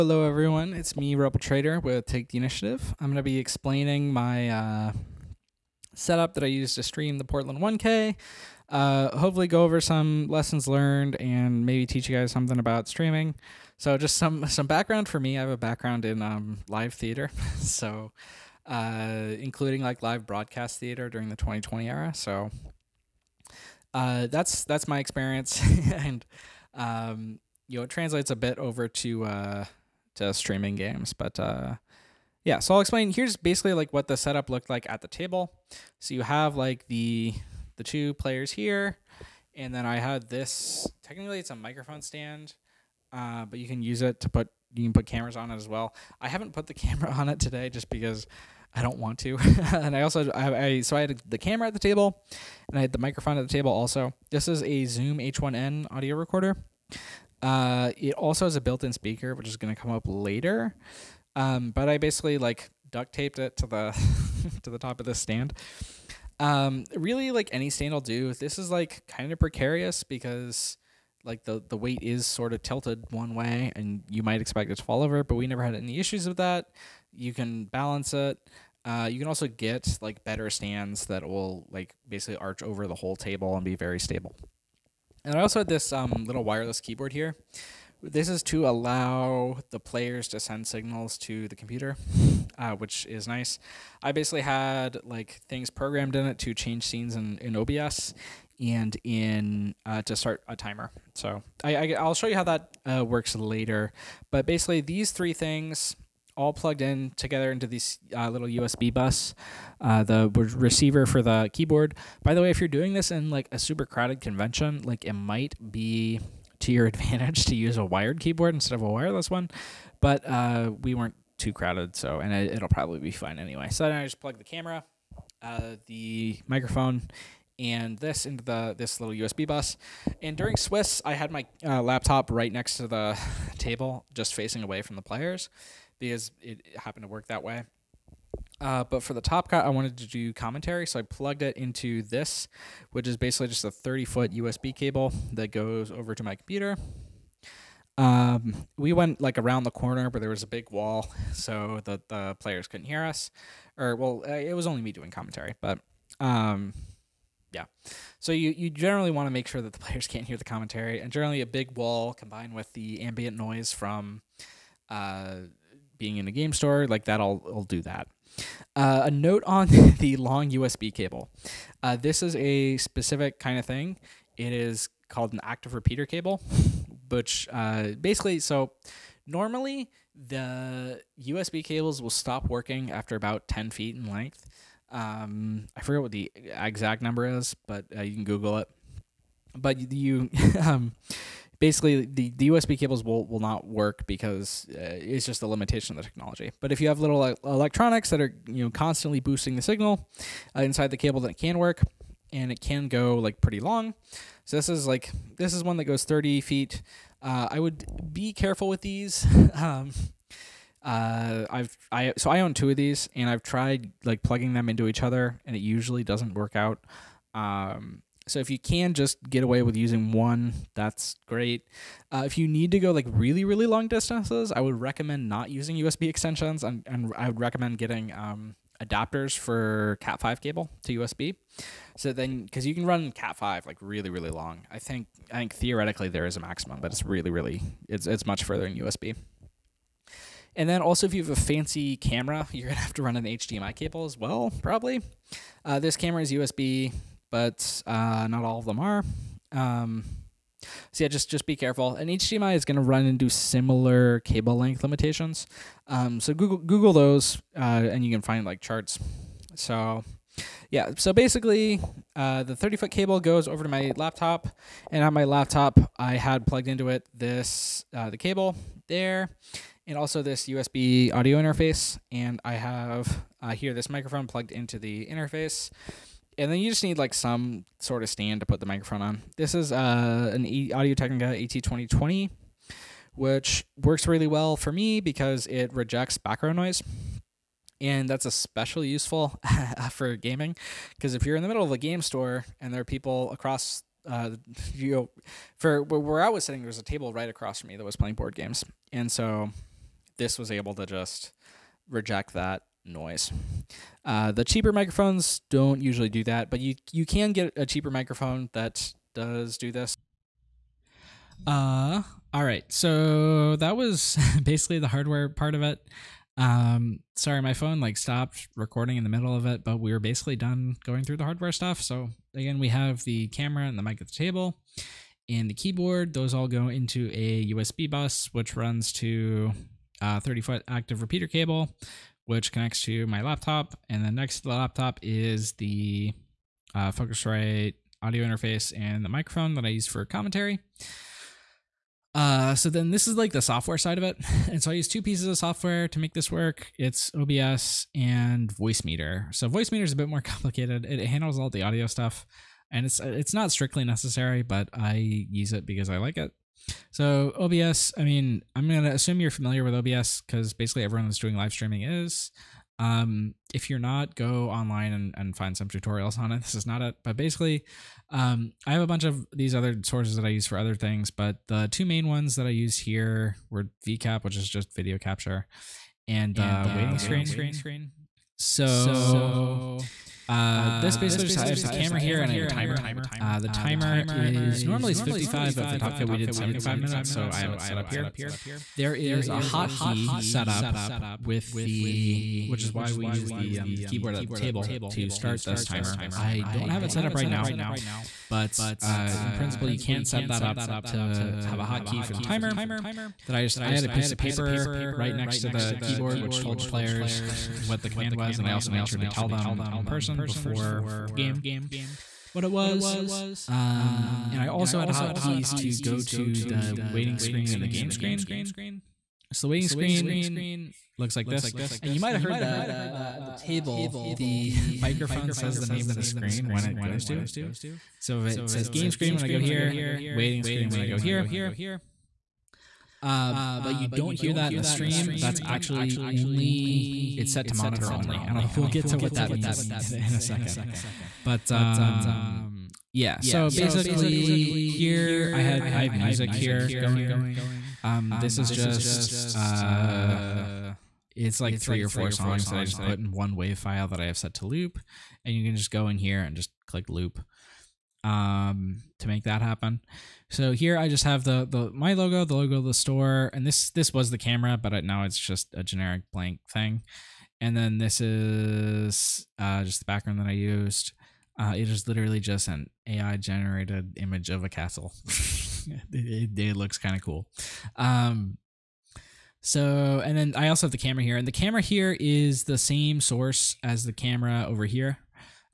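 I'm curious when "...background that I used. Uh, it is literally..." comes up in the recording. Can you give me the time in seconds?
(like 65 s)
469 s.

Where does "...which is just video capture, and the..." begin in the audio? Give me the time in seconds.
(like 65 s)
374 s.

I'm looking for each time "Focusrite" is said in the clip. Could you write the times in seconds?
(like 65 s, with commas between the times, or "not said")
336 s.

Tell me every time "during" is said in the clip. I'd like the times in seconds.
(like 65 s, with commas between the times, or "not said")
21 s, 130 s.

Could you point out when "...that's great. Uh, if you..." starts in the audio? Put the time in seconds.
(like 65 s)
220 s.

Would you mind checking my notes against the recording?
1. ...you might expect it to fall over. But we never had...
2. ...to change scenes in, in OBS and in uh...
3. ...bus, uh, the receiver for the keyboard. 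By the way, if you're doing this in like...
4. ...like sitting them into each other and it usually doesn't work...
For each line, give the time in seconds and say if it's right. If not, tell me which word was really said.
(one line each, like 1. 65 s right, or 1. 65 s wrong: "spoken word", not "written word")
1. 74 s right
2. 96 s right
3. 108 s right
4. 214 s wrong: "plugging", not "sitting".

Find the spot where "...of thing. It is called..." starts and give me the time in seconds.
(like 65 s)
173 s.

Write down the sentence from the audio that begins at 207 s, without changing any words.
Uh, I would be careful with these.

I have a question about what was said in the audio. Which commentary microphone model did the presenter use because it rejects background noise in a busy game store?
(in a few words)
Audio Technica AT2020.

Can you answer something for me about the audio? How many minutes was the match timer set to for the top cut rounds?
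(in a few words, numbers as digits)
75.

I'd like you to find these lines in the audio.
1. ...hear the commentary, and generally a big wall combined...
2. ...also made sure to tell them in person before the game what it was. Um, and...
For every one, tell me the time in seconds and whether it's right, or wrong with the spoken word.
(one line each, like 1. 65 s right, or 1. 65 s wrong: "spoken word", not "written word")
1. 160 s right
2. 408 s right.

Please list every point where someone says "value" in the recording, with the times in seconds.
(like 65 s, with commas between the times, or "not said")
not said.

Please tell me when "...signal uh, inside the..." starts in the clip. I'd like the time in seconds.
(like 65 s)
199 s.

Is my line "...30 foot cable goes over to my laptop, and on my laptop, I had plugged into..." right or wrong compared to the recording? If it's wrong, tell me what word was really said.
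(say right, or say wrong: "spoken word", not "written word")
right.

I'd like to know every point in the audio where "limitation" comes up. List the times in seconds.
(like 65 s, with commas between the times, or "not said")
195 s, 254 s.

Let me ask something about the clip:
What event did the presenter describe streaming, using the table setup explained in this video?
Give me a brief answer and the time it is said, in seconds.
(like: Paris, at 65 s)
Portland 1K, at 7 s.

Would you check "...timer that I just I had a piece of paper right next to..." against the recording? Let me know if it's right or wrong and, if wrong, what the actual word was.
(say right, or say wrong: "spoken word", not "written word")
right.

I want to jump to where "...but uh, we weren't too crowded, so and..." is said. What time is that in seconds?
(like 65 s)
119 s.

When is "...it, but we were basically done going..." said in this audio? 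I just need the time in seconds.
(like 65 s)
319 s.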